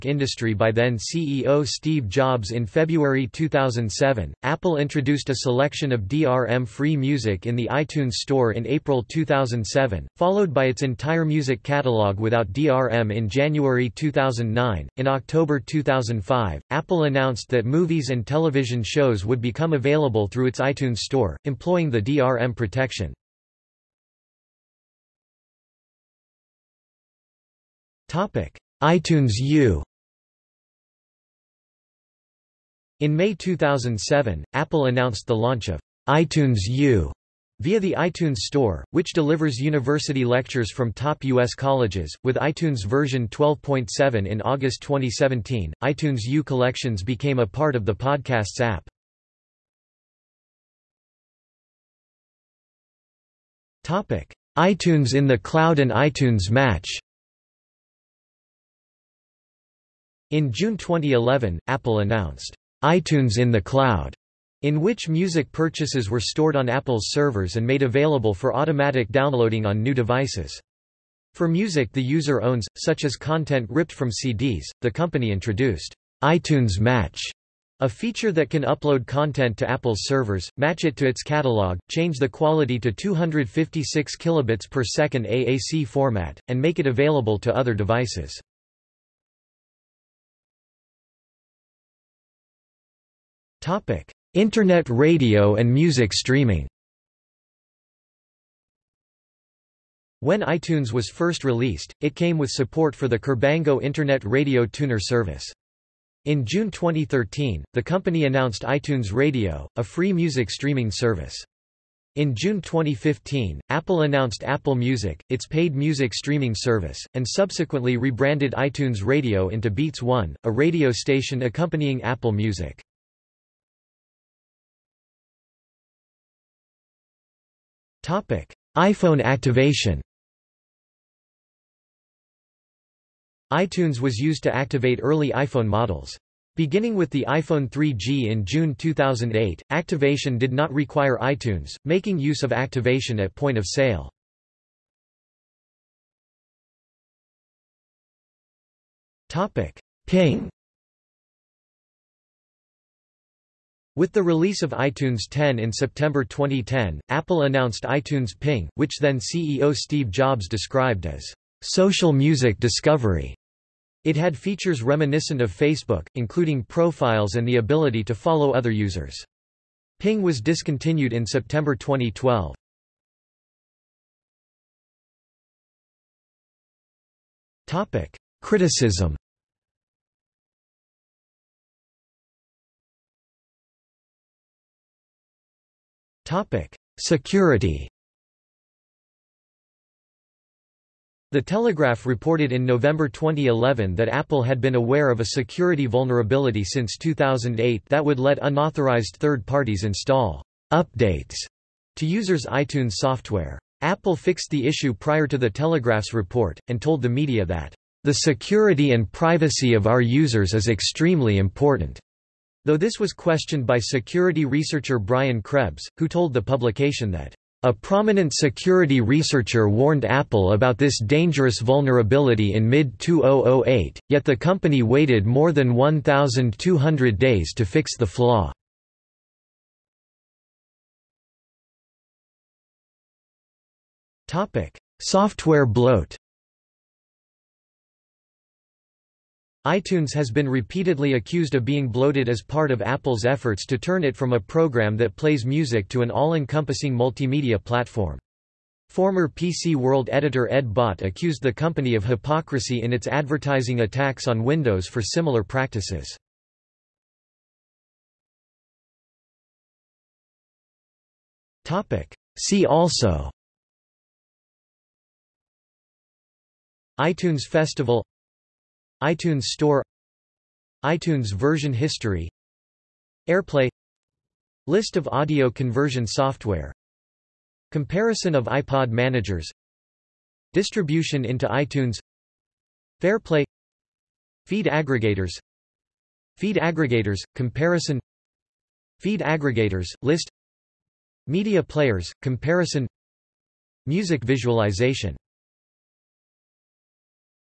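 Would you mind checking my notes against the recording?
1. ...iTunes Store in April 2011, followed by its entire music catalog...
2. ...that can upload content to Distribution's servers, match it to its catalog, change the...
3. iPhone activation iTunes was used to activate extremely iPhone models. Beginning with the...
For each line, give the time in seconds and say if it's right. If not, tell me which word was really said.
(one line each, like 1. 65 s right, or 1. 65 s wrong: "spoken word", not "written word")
1. 7 s wrong: "2007", not "2011"
2. 78 s wrong: "Apple", not "Distribution"
3. 128 s wrong: "early", not "extremely".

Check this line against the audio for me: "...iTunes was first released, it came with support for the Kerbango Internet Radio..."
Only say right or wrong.
right.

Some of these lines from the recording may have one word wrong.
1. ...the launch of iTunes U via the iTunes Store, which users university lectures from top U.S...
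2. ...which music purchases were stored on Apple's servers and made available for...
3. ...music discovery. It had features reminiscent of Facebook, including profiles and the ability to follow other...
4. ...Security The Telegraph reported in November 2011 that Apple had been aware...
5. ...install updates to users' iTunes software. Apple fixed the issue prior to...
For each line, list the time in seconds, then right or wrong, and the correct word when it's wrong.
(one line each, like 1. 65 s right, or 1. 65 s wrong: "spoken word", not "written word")
1. 35 s wrong: "delivers", not "users"
2. 64 s right
3. 162 s right
4. 186 s right
5. 199 s right.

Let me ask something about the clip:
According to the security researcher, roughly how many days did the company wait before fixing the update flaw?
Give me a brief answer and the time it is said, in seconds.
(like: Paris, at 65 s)
more than 1,200, at 225 s.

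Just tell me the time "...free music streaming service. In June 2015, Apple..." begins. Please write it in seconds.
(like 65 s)
109 s.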